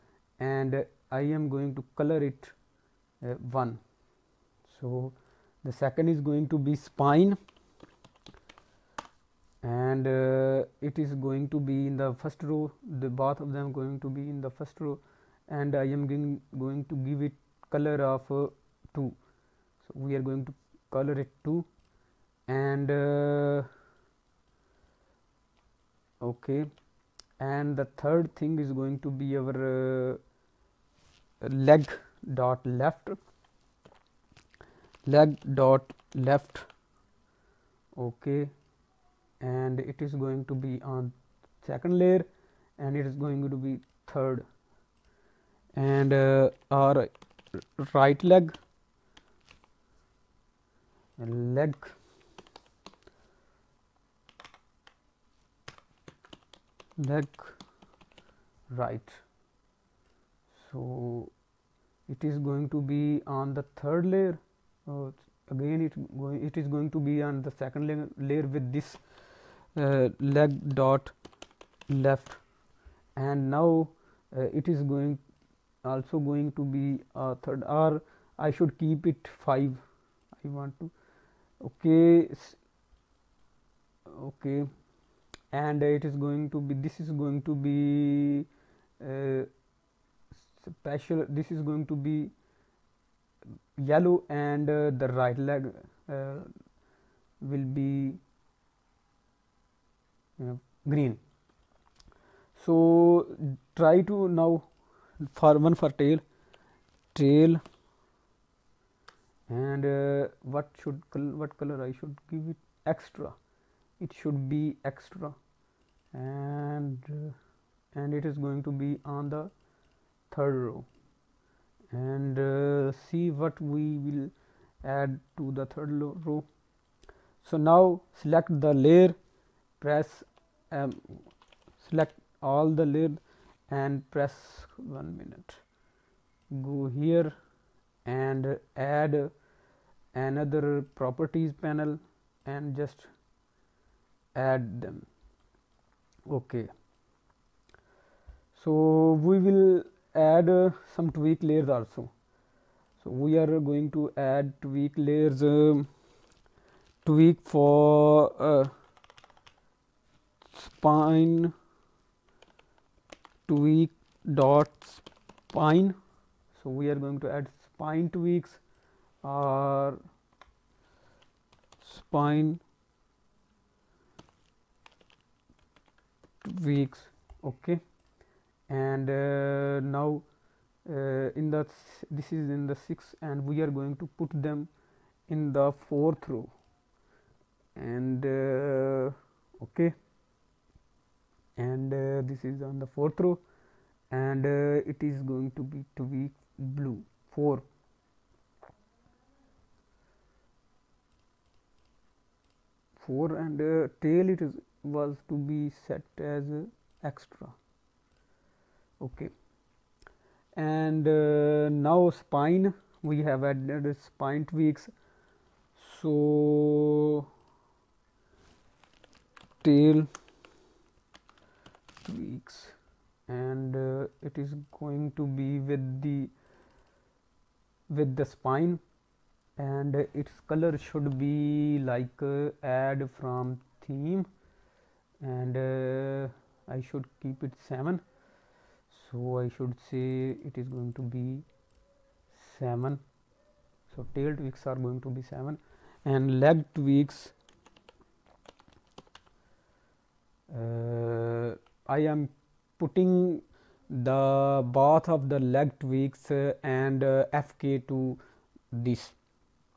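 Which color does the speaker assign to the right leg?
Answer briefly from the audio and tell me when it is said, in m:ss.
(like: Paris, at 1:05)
green, at 1:40.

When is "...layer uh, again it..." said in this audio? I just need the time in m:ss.
1:04.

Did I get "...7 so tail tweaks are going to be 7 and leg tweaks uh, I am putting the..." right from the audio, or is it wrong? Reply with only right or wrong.
right.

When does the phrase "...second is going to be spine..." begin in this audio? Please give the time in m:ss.
0:05.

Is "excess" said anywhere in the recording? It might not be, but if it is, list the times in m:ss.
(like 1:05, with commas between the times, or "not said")
not said.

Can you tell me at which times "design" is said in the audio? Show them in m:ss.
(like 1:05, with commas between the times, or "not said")
not said.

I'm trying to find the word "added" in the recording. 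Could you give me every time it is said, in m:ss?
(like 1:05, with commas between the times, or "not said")
3:33.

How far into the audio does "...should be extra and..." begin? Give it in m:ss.
1:54.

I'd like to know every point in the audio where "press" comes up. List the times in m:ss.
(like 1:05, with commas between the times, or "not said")
2:09, 2:14.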